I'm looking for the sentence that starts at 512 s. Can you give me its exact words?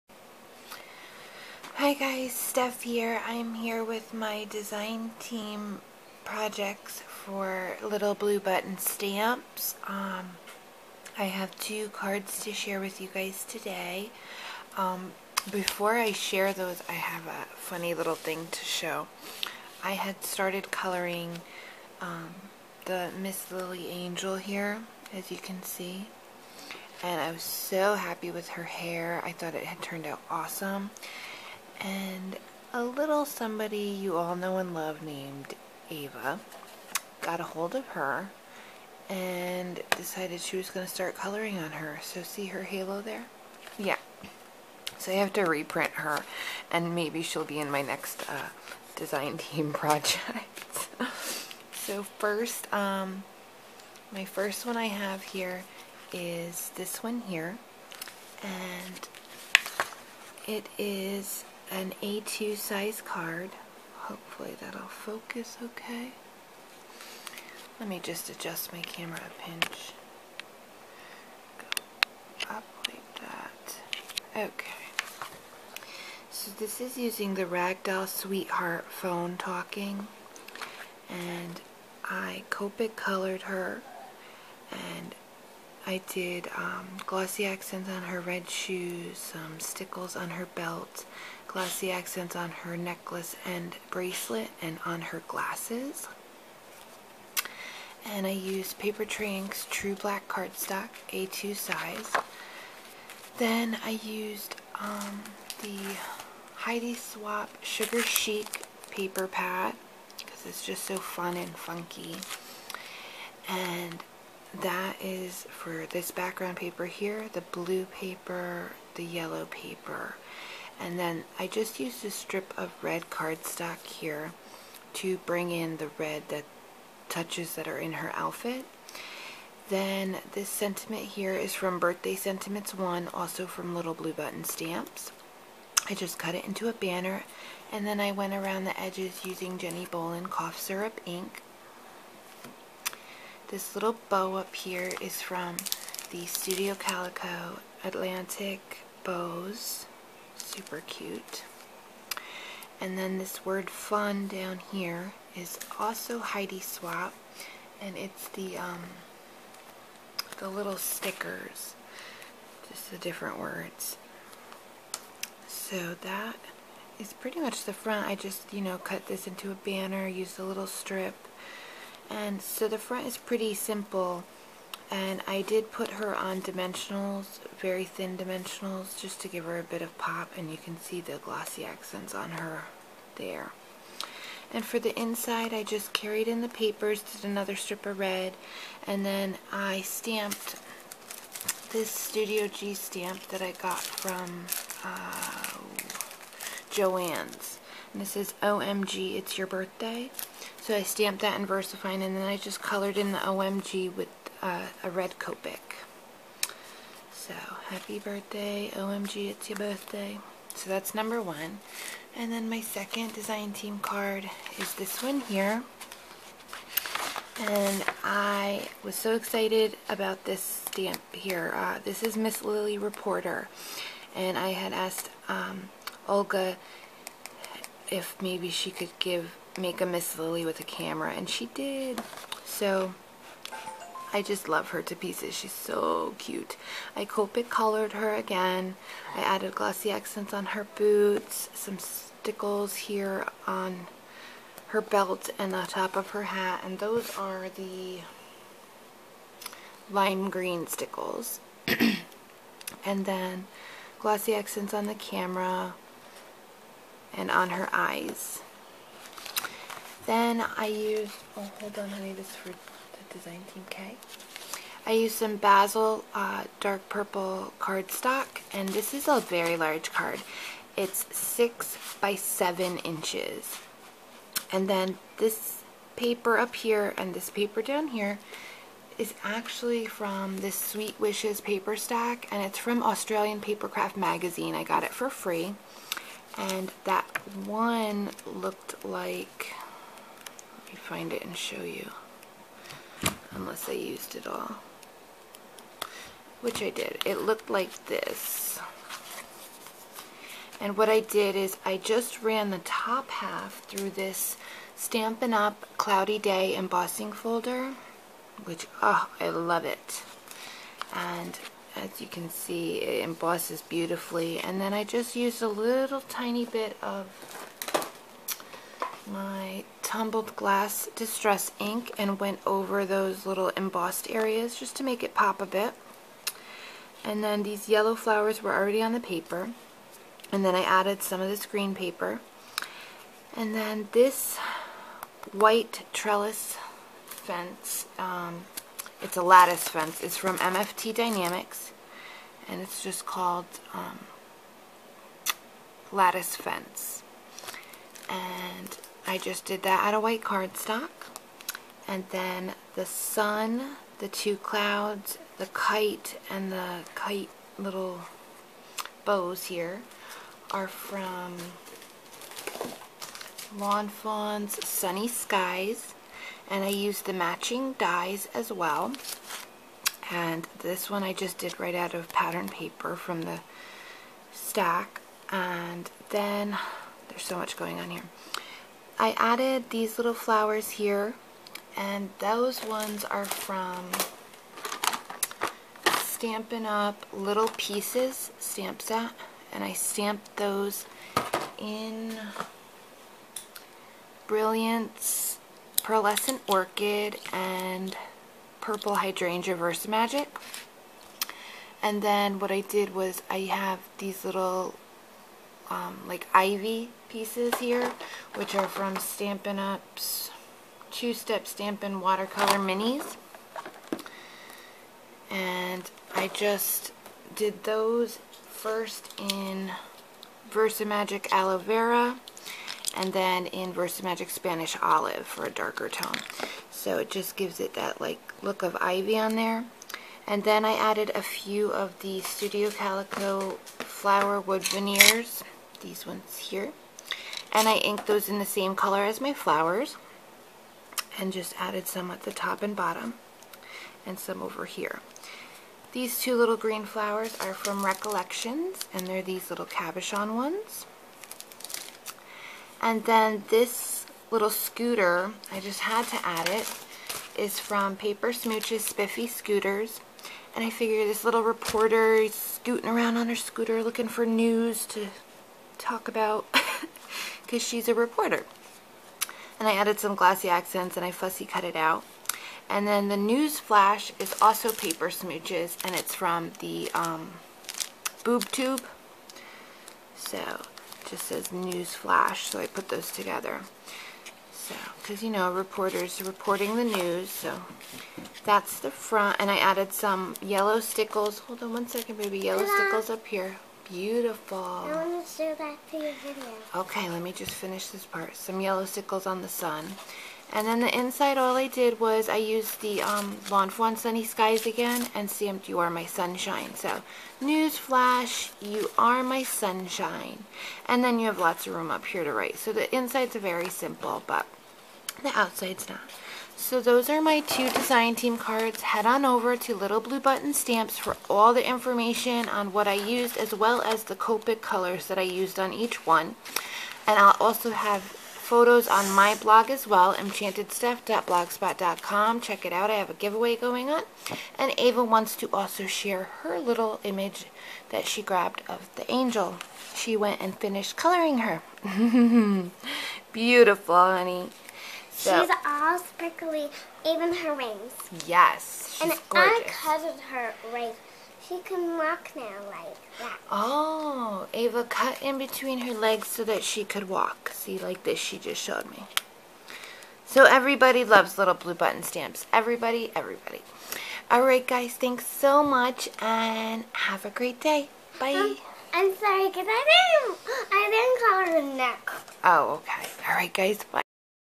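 So the inside's very simple, but the outside's not.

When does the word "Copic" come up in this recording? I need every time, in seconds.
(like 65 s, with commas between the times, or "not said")
82 s, 205 s, 237 s, 524 s.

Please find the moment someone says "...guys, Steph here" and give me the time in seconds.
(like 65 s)
1 s.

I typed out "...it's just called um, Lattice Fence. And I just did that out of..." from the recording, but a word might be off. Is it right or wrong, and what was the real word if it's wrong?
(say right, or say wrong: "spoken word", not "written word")
right.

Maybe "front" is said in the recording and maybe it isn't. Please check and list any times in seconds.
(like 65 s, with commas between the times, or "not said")
167 s, 172 s, 488 s.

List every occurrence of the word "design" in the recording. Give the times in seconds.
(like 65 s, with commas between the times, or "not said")
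4 s, 48 s, 213 s, 263 s, 517 s.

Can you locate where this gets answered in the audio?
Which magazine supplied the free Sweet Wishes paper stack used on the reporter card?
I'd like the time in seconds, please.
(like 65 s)
282 s.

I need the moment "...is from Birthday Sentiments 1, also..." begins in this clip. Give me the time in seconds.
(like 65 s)
131 s.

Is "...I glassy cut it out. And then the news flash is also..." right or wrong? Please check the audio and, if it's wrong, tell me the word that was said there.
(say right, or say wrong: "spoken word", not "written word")
wrong: "fussy", not "glassy".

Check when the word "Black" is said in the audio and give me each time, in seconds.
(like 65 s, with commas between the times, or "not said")
99 s.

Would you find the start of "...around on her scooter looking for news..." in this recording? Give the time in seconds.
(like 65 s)
462 s.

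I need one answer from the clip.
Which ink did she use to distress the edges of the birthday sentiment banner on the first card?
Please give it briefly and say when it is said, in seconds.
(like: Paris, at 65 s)
Jenni Bowlin cough syrup, at 139 s.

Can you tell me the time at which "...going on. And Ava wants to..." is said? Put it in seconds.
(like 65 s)
533 s.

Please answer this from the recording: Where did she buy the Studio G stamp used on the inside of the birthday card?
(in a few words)
Joann's.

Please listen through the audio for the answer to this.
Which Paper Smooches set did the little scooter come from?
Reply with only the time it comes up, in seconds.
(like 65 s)
458 s.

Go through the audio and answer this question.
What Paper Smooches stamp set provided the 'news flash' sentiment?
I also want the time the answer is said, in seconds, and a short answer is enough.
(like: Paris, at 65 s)
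Boob Tube, at 478 s.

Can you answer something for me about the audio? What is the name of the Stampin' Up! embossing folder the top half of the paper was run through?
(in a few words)
Cloudy Day.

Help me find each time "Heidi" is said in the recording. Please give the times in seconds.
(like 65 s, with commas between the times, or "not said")
106 s, 156 s.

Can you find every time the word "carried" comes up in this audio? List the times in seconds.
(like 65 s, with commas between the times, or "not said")
185 s.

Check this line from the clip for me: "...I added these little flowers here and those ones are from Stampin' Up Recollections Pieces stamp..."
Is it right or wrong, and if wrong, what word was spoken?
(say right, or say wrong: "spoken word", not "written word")
wrong: "Little", not "Recollections".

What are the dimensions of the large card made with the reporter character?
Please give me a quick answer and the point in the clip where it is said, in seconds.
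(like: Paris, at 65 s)
6 by 7 inches, at 271 s.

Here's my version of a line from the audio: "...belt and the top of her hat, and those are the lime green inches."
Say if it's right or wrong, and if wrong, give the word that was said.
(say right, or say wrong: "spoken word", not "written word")
wrong: "stickles", not "inches".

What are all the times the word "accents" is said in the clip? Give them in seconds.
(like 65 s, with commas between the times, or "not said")
87 s, 91 s, 181 s, 239 s, 254 s, 470 s.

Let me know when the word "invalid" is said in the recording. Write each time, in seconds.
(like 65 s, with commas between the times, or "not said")
not said.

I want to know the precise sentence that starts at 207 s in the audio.
So happy birthday, OMG, it's your birthday.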